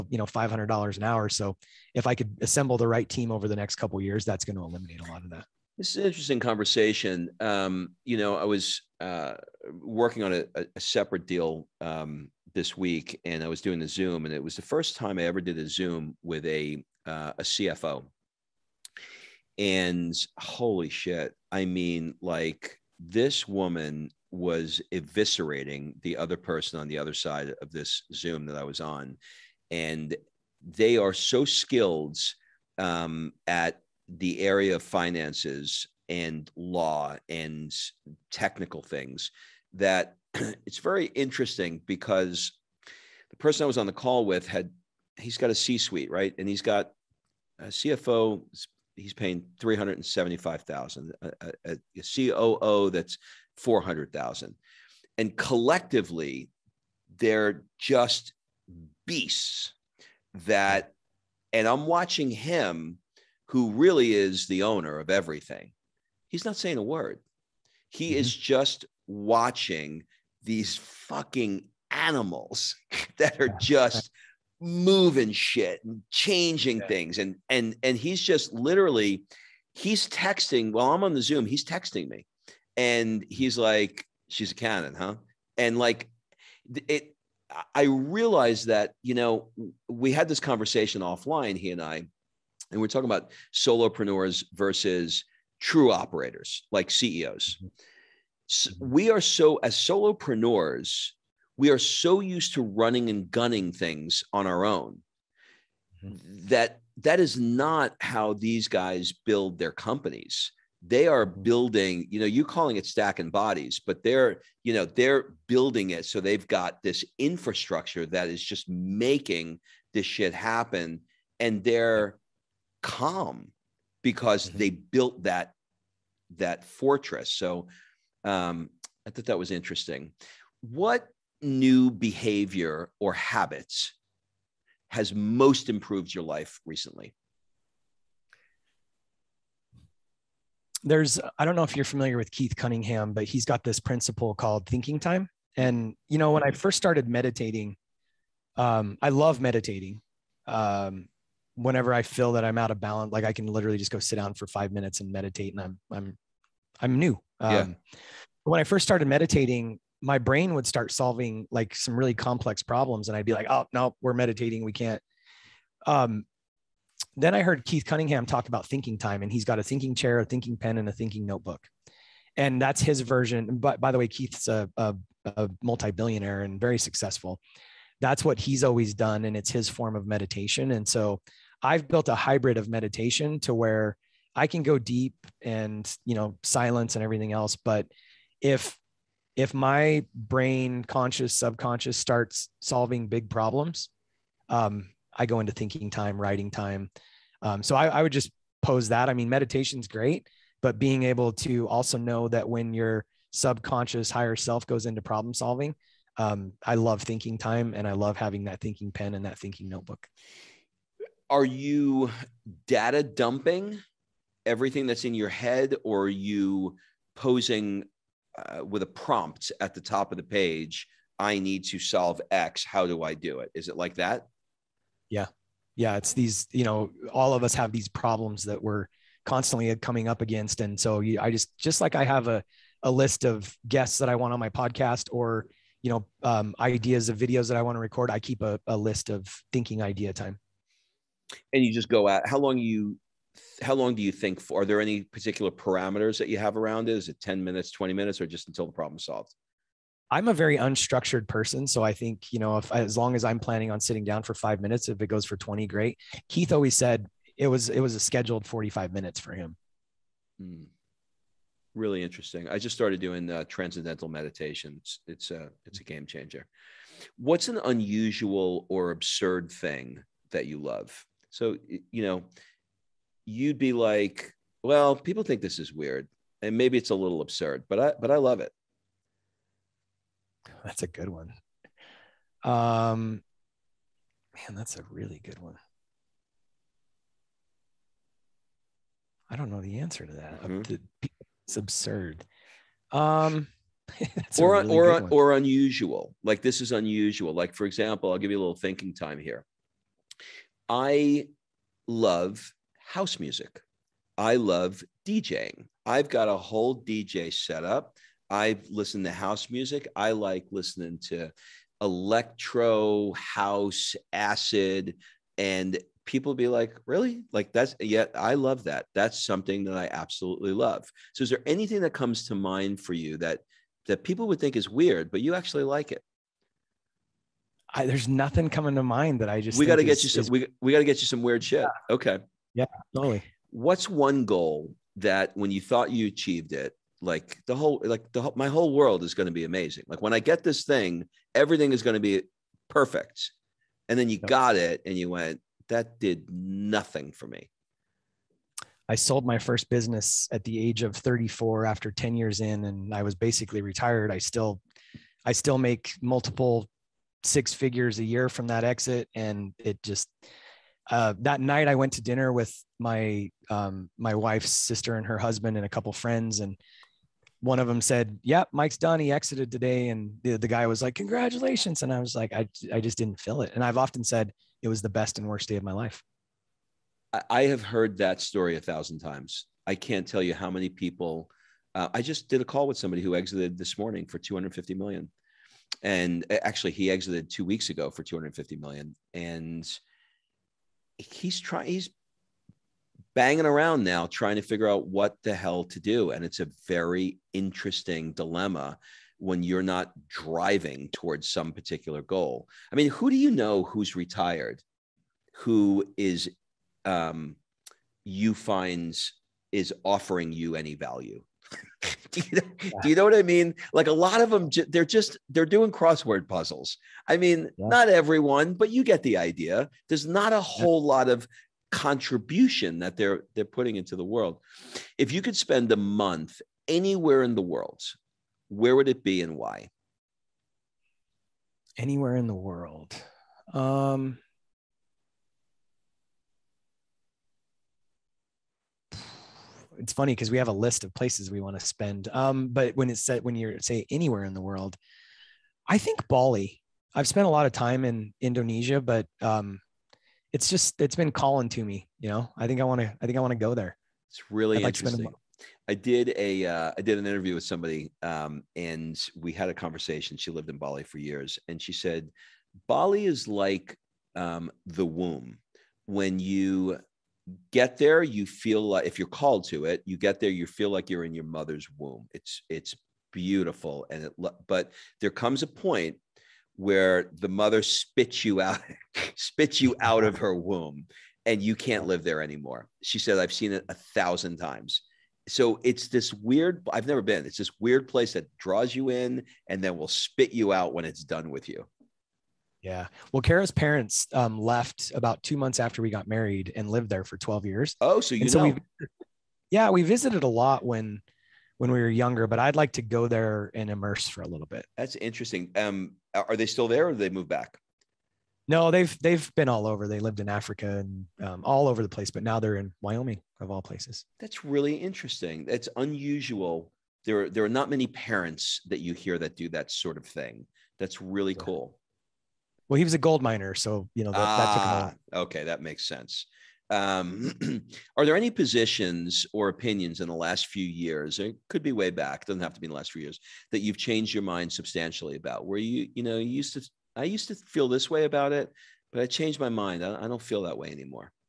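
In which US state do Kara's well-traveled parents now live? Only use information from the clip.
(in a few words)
Wyoming.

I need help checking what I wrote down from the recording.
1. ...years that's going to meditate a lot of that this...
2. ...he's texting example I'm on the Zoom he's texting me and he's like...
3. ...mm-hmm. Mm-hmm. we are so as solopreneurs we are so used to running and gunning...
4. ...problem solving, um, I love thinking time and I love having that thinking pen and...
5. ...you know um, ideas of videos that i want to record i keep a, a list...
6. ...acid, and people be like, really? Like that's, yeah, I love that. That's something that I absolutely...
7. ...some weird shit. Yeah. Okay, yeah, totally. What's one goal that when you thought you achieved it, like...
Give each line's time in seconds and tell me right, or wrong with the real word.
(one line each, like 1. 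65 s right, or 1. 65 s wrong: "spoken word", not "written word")
1. 4 s wrong: "eliminate", not "meditate"
2. 79 s wrong: "while", not "example"
3. 97 s right
4. 205 s right
5. 235 s right
6. 314 s right
7. 331 s right.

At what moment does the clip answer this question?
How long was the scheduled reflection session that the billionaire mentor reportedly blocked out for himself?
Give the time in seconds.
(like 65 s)
258 s.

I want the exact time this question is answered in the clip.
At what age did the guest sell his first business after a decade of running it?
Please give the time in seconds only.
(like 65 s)
350 s.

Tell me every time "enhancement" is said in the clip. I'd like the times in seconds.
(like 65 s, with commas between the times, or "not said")
not said.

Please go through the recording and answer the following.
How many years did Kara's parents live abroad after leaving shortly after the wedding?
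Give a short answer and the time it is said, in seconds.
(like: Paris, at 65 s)
12 years, at 497 s.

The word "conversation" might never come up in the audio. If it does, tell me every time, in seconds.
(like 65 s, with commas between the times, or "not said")
6 s, 90 s, 459 s.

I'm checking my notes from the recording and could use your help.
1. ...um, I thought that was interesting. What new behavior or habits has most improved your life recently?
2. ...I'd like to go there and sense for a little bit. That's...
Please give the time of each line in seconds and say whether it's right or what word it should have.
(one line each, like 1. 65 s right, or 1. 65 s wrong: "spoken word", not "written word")
1. 128 s right
2. 502 s wrong: "immerse", not "sense".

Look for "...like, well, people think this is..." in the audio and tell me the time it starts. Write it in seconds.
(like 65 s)
273 s.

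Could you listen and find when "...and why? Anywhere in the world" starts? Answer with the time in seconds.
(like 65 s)
429 s.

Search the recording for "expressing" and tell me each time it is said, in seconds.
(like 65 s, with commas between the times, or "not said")
not said.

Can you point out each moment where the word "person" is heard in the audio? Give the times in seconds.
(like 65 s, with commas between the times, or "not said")
26 s, 43 s, 251 s.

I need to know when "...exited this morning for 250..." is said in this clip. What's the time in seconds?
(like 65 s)
383 s.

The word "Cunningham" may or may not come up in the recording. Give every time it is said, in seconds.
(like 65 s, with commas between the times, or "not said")
142 s, 167 s.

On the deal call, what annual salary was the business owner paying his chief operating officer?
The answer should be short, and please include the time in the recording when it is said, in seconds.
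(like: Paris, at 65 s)
$400,000, at 53 s.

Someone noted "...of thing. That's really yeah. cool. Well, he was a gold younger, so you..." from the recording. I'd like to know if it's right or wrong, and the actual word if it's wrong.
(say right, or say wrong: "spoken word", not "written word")
wrong: "miner", not "younger".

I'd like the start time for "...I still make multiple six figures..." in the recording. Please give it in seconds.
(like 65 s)
355 s.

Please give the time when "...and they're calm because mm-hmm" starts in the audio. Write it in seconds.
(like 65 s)
121 s.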